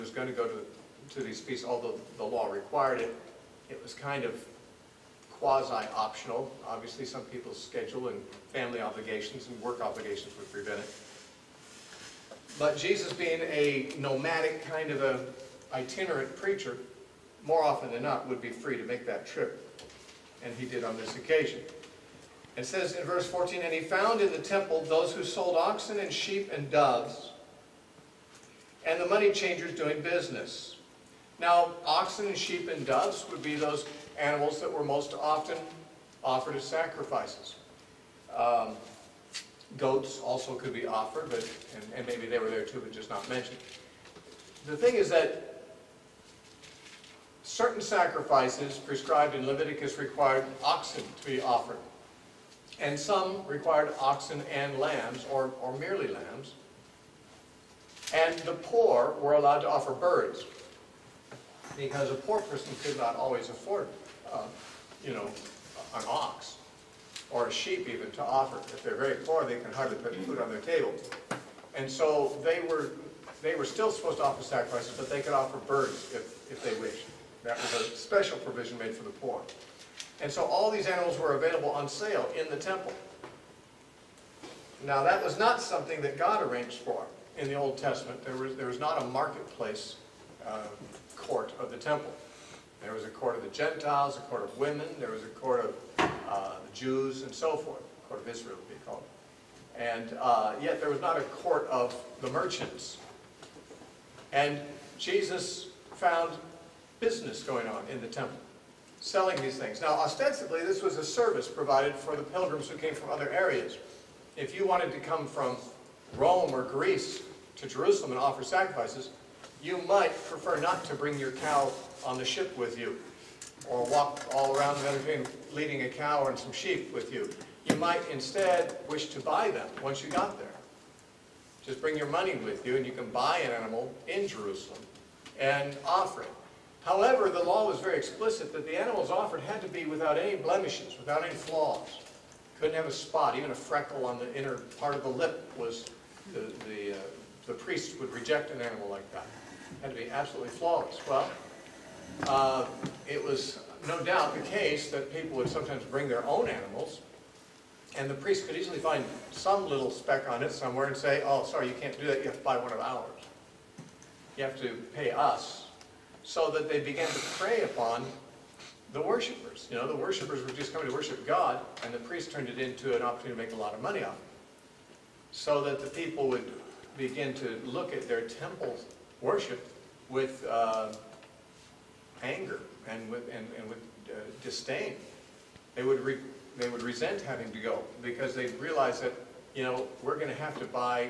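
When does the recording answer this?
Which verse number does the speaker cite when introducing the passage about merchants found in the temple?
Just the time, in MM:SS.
00:23.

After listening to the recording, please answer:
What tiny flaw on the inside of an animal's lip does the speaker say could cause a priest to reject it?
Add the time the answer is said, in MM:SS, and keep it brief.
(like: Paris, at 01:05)
A freckle, at 02:23.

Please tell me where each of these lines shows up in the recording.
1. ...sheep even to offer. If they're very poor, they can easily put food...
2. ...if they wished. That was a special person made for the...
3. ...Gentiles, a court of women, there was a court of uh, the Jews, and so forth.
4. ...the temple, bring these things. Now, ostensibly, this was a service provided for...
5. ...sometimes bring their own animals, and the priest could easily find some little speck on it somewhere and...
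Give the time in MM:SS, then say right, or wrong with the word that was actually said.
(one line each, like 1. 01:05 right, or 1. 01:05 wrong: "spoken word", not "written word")
1. 01:07 wrong: "hardly", not "easily"
2. 01:16 wrong: "provision", not "person"
3. 01:33 right
4. 01:48 wrong: "selling", not "bring"
5. 02:35 right.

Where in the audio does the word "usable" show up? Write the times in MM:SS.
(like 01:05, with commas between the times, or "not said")
not said.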